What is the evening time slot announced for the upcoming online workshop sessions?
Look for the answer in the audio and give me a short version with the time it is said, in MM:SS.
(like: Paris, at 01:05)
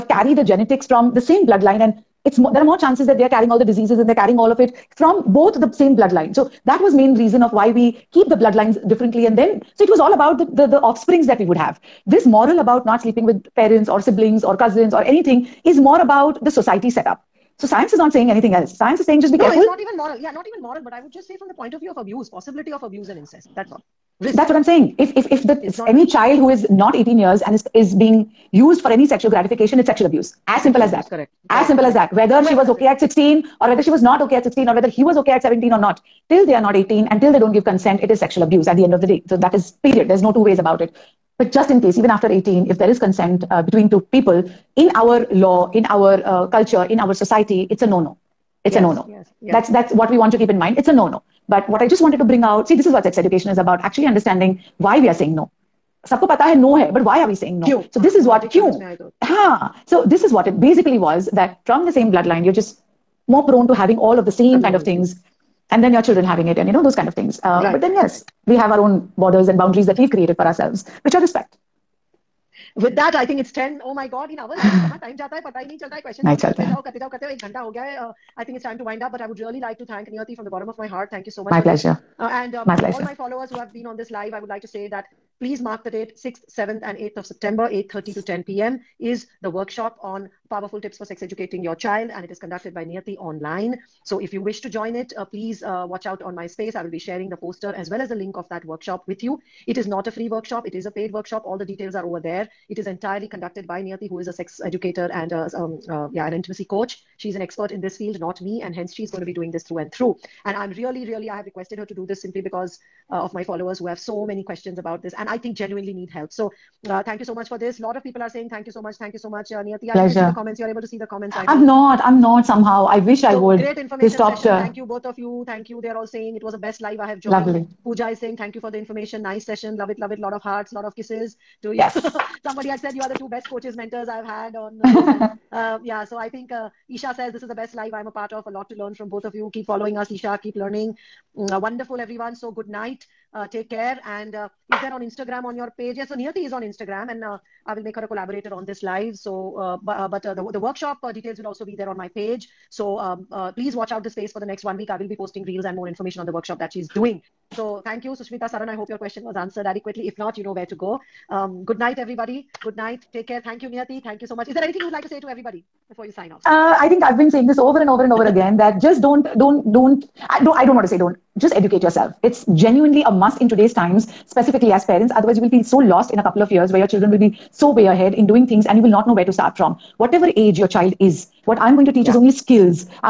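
8:30 to 10 pm, at 01:27.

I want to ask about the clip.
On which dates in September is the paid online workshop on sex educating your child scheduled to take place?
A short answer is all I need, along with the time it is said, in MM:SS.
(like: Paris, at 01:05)
6th, 7th and 8th, at 01:26.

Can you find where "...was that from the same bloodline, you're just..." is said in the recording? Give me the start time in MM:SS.
01:00.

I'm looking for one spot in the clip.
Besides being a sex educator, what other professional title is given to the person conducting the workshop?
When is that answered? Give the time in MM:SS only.
01:46.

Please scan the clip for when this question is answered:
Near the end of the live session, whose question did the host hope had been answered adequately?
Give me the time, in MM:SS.
02:38.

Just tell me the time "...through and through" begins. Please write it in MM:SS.
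01:49.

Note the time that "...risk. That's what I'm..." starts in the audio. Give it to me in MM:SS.
00:24.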